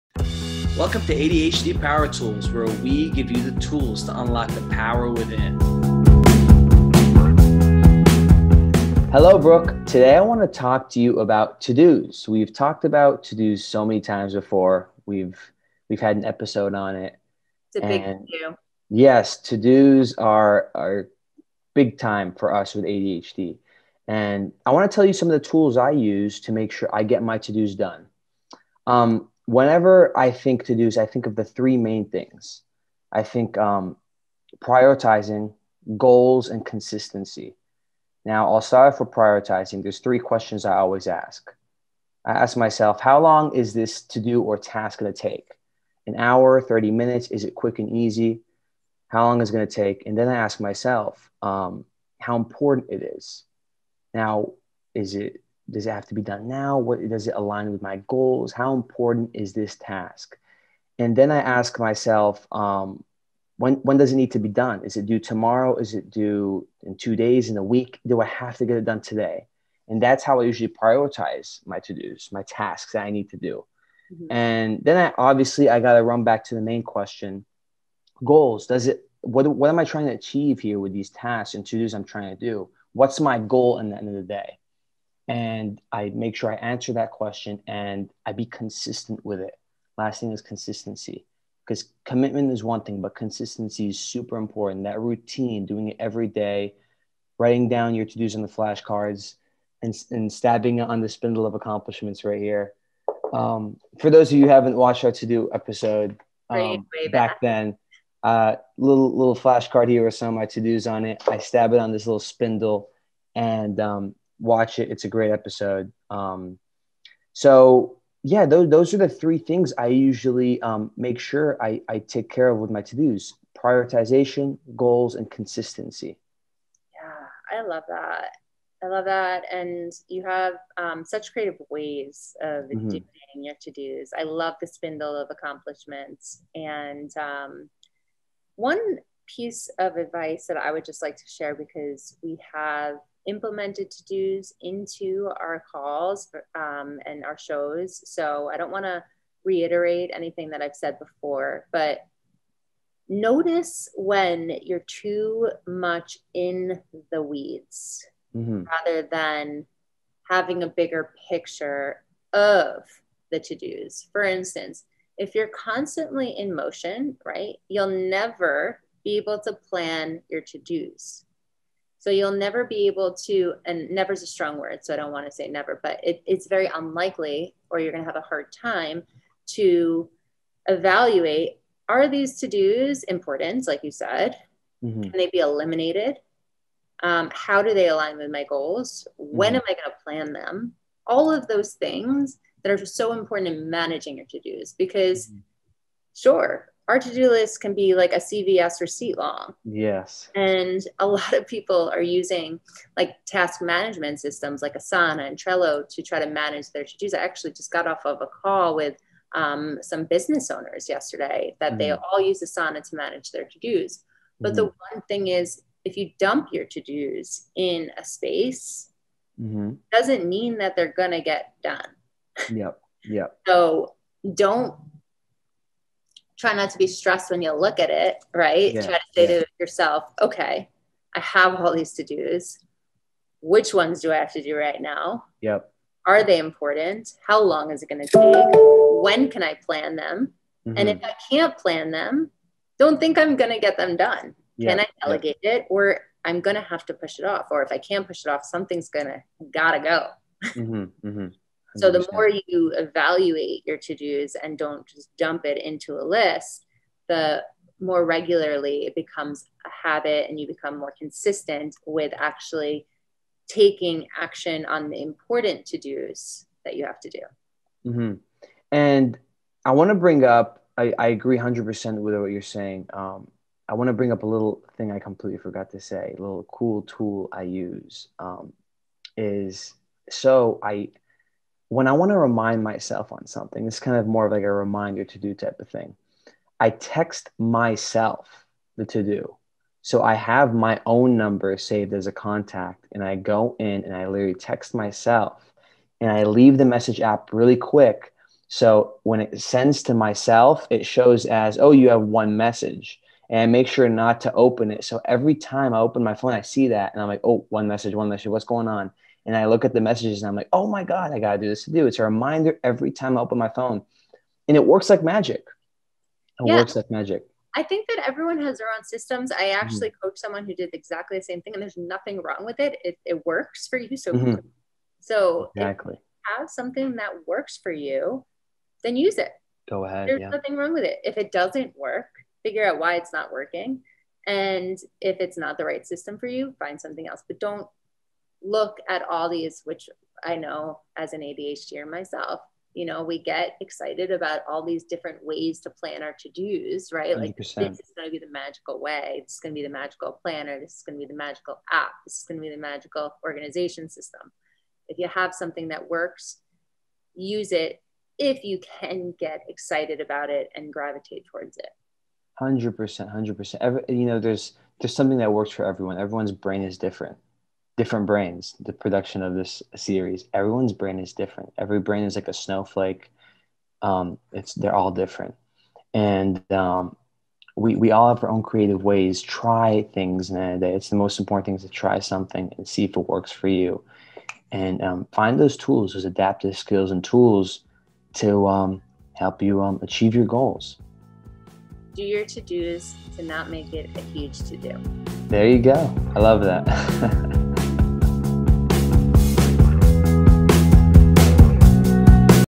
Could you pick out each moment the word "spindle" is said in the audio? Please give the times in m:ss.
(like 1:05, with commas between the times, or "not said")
1:41, 1:52, 2:14.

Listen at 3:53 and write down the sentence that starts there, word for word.
Which ones do I have to do right now?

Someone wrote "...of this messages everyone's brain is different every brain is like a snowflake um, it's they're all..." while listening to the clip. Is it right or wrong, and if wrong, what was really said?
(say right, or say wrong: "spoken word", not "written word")
wrong: "series", not "messages".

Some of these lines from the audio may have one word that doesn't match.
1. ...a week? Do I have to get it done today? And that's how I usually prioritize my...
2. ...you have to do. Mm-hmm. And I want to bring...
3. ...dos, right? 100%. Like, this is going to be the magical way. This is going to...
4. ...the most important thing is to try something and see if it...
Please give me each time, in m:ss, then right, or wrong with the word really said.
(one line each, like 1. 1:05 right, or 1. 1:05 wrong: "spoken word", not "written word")
1. 1:07 right
2. 4:26 right
3. 5:46 right
4. 6:20 right.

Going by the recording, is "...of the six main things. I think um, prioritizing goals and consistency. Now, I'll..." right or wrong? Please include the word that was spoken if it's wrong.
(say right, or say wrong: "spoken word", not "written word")
wrong: "three", not "six".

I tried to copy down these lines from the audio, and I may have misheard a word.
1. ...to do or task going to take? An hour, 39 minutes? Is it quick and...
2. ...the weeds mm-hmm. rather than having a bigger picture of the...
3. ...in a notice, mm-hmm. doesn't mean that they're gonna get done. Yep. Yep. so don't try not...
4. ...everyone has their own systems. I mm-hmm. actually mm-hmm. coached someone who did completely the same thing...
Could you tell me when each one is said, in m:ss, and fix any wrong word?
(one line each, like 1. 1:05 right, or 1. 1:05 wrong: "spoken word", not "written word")
1. 0:44 wrong: "30", not "39"
2. 2:37 right
3. 3:37 wrong: "space", not "notice"
4. 5:18 wrong: "exactly", not "completely".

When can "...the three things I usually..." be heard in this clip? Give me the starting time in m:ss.
1:58.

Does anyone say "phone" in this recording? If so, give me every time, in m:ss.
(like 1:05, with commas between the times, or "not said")
5:06, 5:13.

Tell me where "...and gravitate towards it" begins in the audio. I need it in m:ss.
6:00.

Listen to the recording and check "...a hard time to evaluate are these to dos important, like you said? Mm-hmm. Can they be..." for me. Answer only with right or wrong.
right.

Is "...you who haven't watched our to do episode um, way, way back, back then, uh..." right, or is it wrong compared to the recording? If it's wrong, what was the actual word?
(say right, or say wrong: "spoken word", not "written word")
right.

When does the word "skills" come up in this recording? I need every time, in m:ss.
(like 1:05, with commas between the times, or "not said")
6:26.